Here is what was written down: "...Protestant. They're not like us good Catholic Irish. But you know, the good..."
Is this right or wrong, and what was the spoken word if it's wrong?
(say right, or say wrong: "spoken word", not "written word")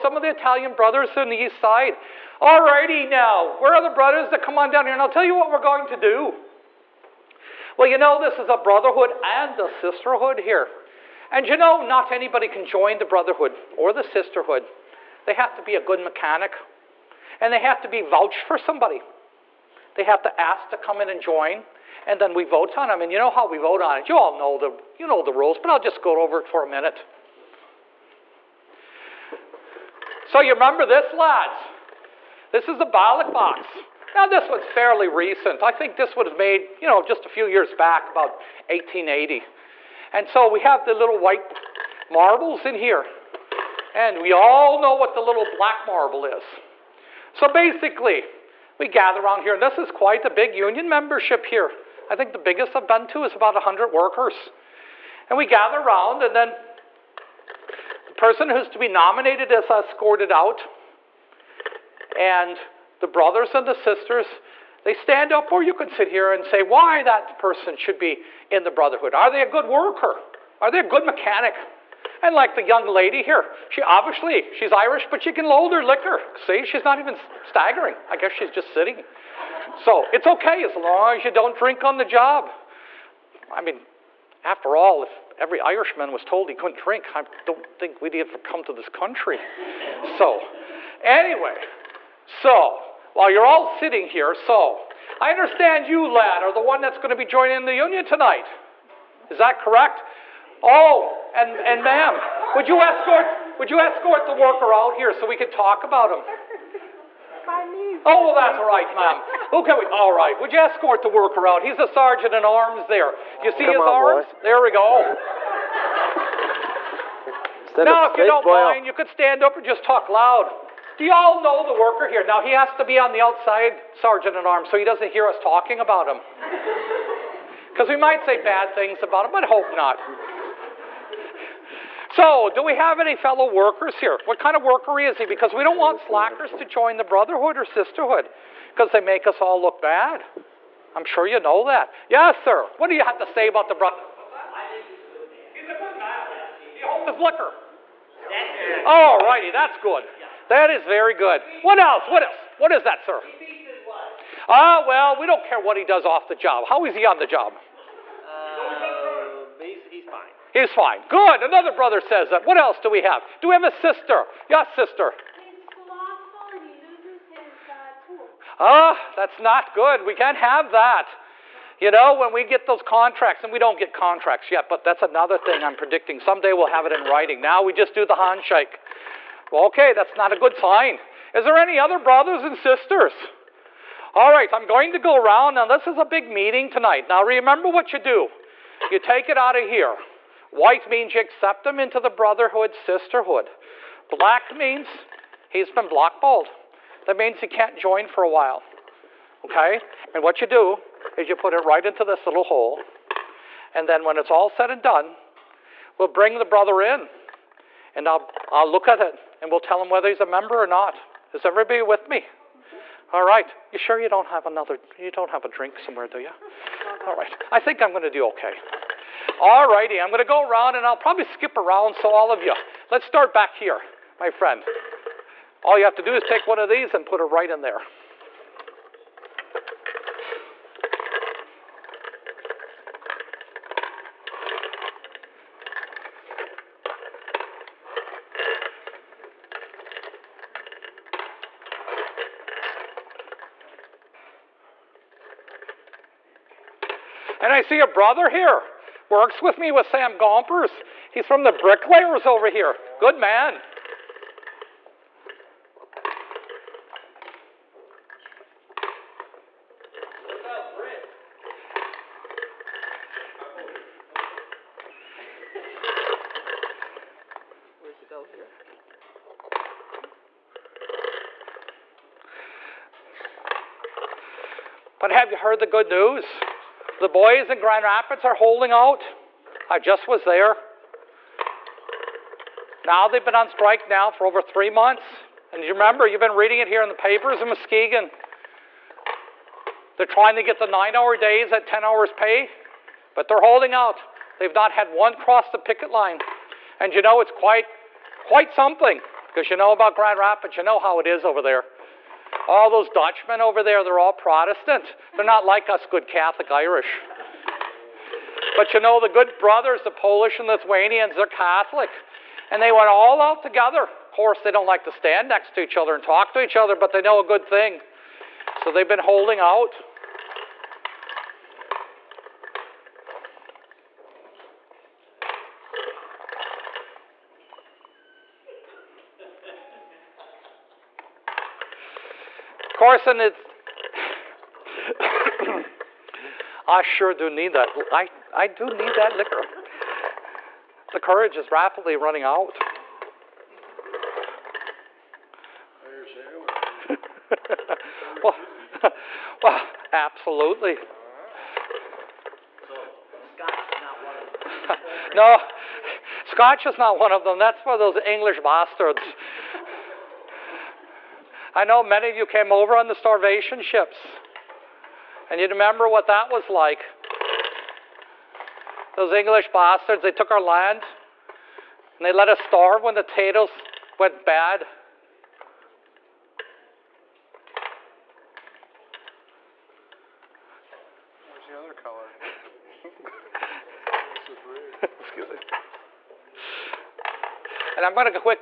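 right.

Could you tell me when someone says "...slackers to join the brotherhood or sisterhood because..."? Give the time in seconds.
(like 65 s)
135 s.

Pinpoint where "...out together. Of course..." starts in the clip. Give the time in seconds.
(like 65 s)
313 s.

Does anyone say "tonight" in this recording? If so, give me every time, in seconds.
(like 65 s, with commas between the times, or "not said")
98 s, 186 s.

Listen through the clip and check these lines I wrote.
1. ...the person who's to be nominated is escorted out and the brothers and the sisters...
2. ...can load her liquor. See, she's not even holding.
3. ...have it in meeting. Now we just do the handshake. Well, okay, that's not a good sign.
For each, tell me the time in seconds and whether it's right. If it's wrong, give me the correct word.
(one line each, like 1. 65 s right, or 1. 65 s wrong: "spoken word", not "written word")
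1. 58 s right
2. 75 s wrong: "staggering", not "holding"
3. 176 s wrong: "writing", not "meeting".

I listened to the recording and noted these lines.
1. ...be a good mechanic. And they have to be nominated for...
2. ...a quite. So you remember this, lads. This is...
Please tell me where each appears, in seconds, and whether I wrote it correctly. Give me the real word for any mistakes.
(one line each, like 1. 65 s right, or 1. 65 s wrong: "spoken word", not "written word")
1. 15 s wrong: "vouched", not "nominated"
2. 26 s wrong: "minute", not "quite".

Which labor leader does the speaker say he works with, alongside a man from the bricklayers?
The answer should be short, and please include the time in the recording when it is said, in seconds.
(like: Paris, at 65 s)
Sam Gompers, at 249 s.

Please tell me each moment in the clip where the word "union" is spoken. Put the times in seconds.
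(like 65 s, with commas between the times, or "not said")
50 s, 97 s.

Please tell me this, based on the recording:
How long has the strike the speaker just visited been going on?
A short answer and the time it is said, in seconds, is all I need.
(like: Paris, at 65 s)
over three months, at 284 s.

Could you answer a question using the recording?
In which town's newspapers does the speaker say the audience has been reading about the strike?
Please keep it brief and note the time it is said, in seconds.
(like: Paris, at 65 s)
Muskegon, at 287 s.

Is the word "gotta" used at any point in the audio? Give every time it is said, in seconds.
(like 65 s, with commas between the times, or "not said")
not said.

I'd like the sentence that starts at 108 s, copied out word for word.
Oh, well, that's all right, ma'am.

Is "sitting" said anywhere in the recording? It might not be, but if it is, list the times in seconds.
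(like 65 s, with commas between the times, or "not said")
78 s, 93 s.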